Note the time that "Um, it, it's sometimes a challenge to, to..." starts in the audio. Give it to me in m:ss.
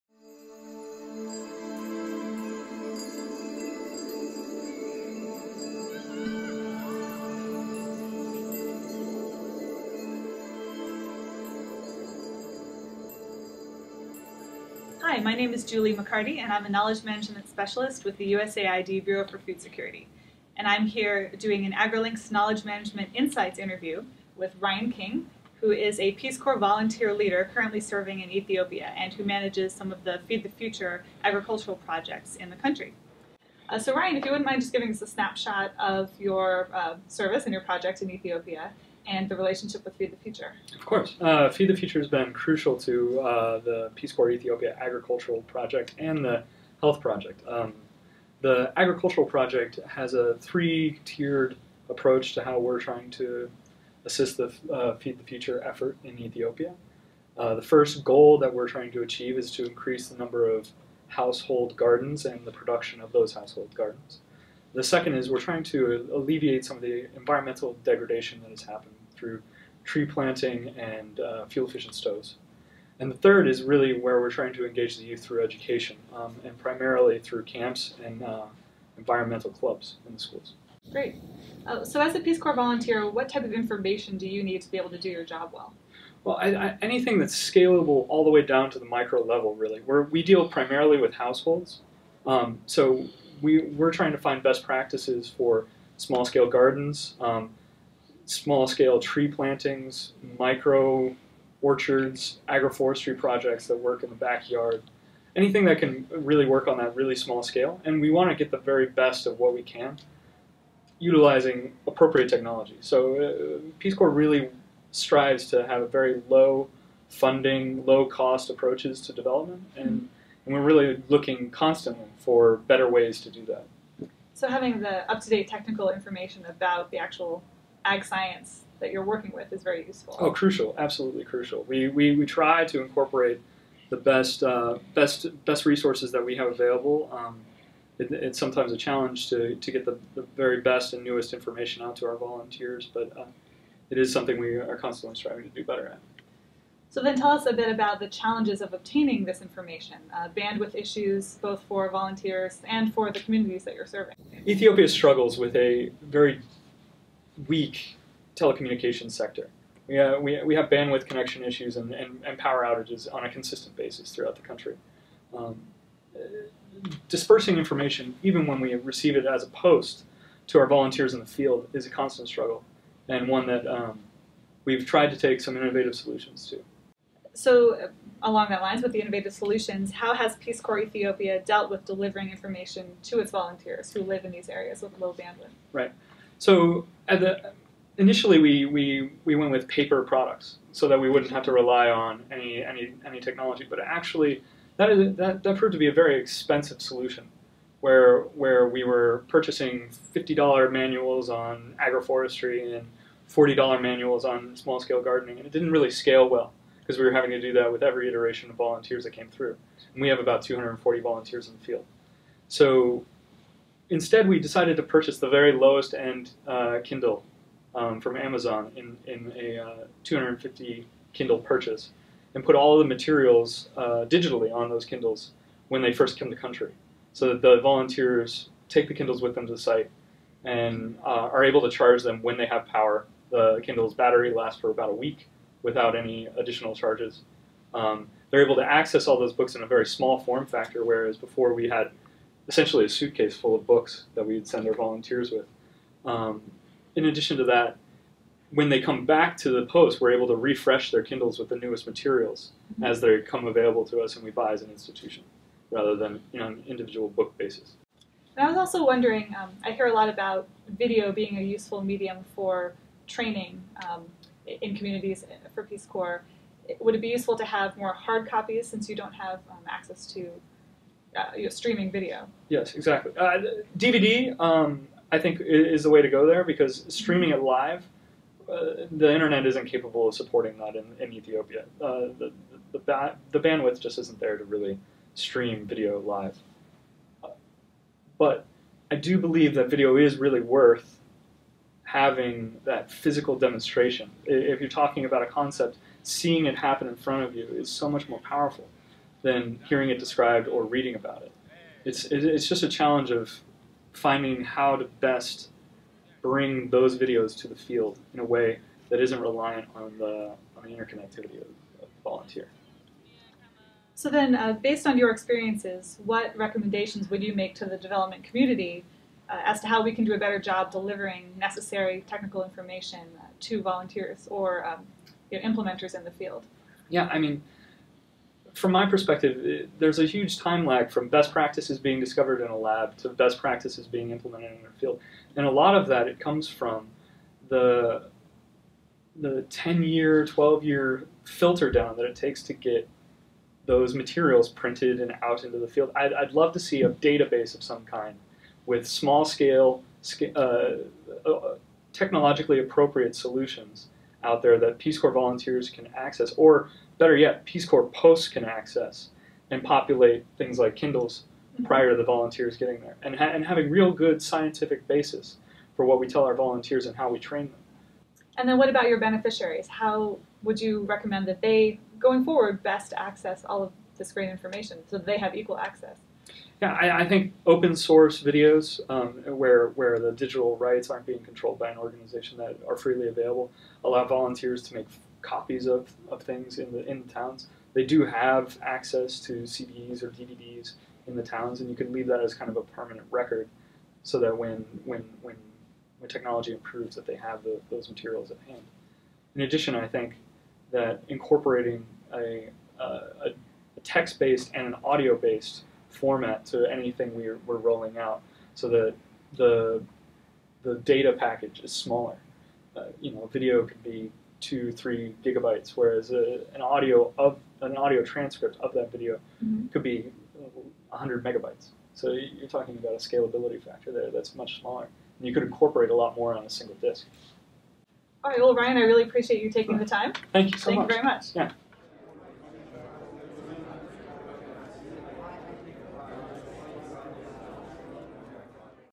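2:17.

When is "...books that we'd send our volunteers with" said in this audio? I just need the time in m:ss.
4:03.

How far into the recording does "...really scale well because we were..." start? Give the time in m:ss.
3:25.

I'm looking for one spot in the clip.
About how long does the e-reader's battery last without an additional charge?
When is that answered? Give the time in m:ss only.
3:54.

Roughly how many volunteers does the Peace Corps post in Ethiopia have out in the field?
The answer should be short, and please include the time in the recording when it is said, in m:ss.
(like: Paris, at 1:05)
240, at 3:30.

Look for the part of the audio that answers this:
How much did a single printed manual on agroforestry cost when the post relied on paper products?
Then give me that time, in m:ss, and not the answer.
3:20.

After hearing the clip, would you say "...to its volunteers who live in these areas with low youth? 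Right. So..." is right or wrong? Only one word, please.
wrong.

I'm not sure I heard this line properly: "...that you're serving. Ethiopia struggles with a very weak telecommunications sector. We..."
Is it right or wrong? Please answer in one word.
right.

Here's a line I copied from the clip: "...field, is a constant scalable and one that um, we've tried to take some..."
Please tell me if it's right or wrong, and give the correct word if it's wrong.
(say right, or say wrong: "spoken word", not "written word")
wrong: "struggle", not "scalable".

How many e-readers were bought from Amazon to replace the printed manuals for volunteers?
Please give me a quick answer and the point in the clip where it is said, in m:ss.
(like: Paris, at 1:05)
250, at 3:40.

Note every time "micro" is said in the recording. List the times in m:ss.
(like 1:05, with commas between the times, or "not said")
1:28, 1:40.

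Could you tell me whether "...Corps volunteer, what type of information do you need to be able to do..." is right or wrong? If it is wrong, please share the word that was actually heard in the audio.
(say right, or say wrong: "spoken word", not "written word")
right.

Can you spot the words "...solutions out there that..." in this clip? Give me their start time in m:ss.
5:53.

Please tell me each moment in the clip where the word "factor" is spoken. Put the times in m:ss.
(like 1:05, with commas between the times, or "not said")
4:00, 7:03.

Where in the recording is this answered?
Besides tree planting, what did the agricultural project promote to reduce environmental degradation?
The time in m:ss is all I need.
1:11.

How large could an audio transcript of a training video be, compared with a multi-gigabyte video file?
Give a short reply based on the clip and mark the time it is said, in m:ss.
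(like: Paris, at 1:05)
100 megabytes, at 7:00.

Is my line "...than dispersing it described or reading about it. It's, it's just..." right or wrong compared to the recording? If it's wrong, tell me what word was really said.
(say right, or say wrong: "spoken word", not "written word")
wrong: "hearing", not "dispersing".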